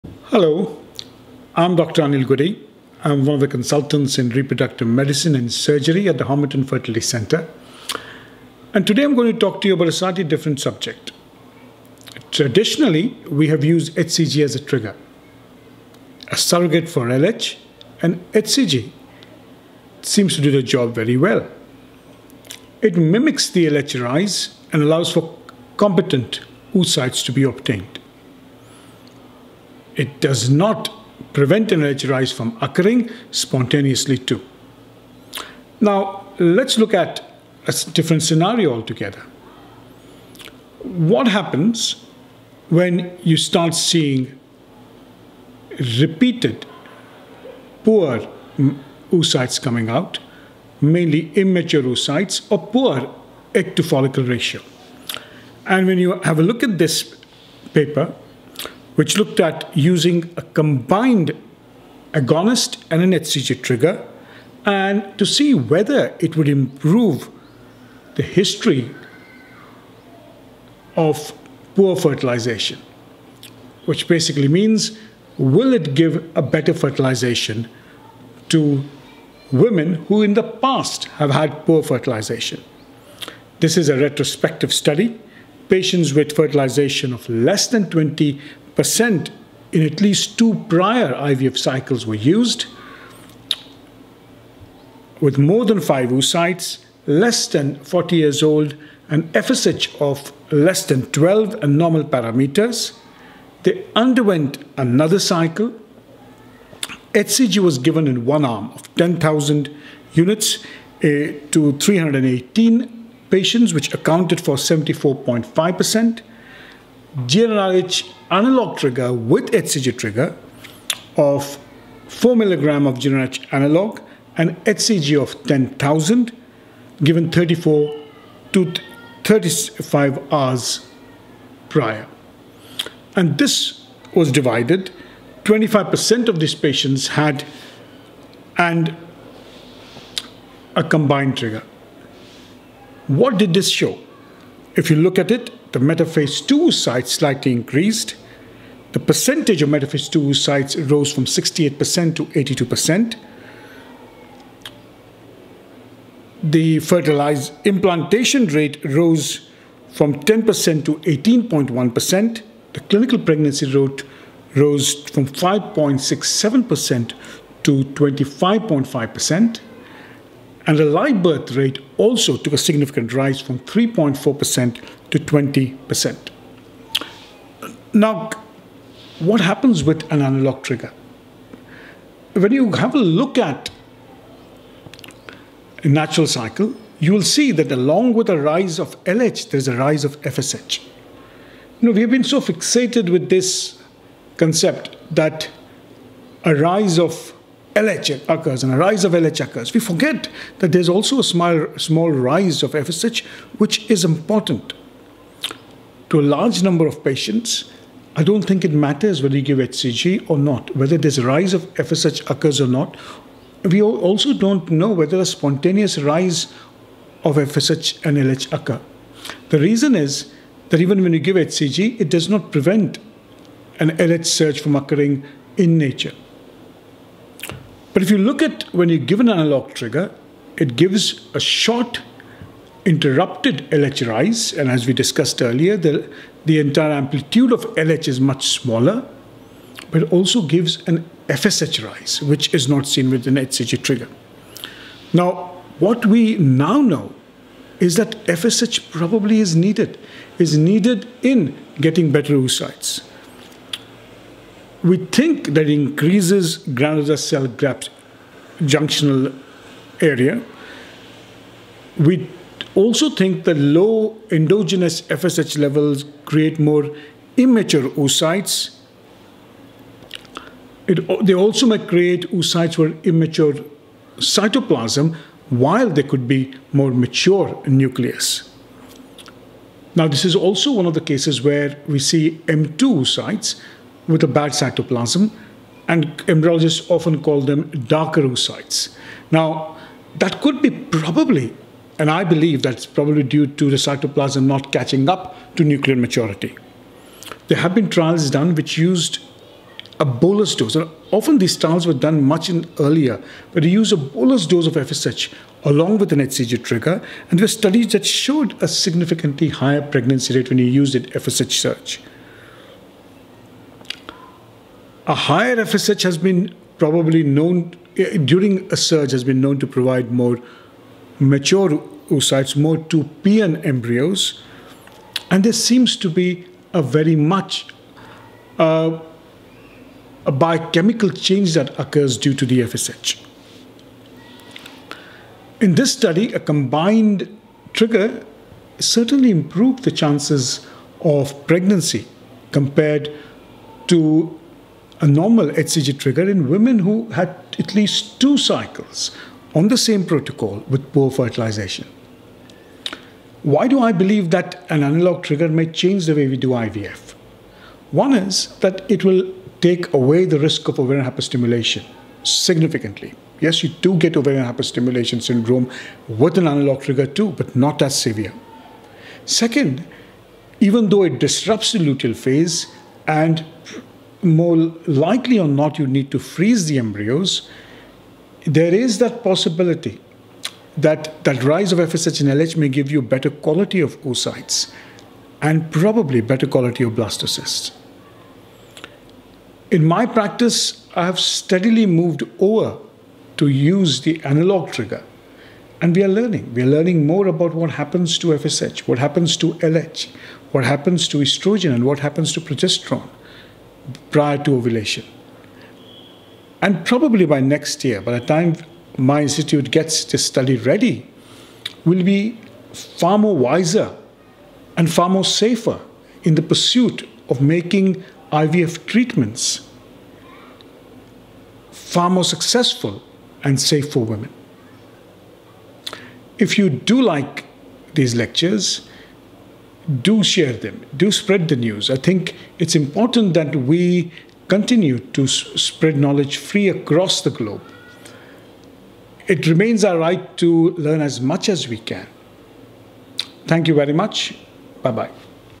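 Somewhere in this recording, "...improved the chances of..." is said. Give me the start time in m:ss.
5:39.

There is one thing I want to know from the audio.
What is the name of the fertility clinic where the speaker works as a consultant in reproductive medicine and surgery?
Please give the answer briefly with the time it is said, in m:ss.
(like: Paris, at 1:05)
Homerton Fertility Center, at 0:06.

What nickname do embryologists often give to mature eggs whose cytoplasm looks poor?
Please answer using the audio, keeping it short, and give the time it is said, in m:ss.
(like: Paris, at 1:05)
dark oocytes, at 4:47.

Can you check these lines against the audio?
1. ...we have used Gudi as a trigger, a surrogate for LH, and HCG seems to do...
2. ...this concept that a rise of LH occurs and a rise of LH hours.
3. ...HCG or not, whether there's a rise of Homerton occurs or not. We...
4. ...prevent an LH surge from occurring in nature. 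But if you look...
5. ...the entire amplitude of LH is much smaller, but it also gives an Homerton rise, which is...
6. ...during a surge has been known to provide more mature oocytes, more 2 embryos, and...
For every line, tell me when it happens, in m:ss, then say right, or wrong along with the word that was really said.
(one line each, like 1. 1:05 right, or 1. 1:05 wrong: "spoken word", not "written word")
1. 0:13 wrong: "HCG", not "Gudi"
2. 3:13 wrong: "occurs", not "hours"
3. 3:29 wrong: "FSH", not "Homerton"
4. 3:42 right
5. 3:56 wrong: "FSH", not "Homerton"
6. 5:18 right.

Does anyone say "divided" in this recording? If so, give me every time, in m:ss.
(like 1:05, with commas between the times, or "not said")
2:14.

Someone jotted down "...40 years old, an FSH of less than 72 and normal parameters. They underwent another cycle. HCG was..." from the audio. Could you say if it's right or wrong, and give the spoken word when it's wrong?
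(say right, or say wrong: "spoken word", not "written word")
wrong: "12", not "72".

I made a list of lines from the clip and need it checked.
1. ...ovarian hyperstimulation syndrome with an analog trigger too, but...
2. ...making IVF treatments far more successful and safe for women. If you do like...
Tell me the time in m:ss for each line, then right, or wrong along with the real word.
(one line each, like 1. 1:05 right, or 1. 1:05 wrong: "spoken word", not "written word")
1. 6:04 right
2. 6:57 right.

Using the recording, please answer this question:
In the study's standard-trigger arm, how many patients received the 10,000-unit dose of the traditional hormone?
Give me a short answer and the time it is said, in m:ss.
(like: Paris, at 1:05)
318, at 1:51.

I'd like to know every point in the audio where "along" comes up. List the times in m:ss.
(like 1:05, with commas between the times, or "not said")
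3:07, 5:05.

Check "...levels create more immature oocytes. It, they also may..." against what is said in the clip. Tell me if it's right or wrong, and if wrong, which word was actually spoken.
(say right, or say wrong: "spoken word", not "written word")
right.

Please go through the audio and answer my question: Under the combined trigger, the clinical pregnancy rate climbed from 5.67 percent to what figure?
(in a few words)
25.5%.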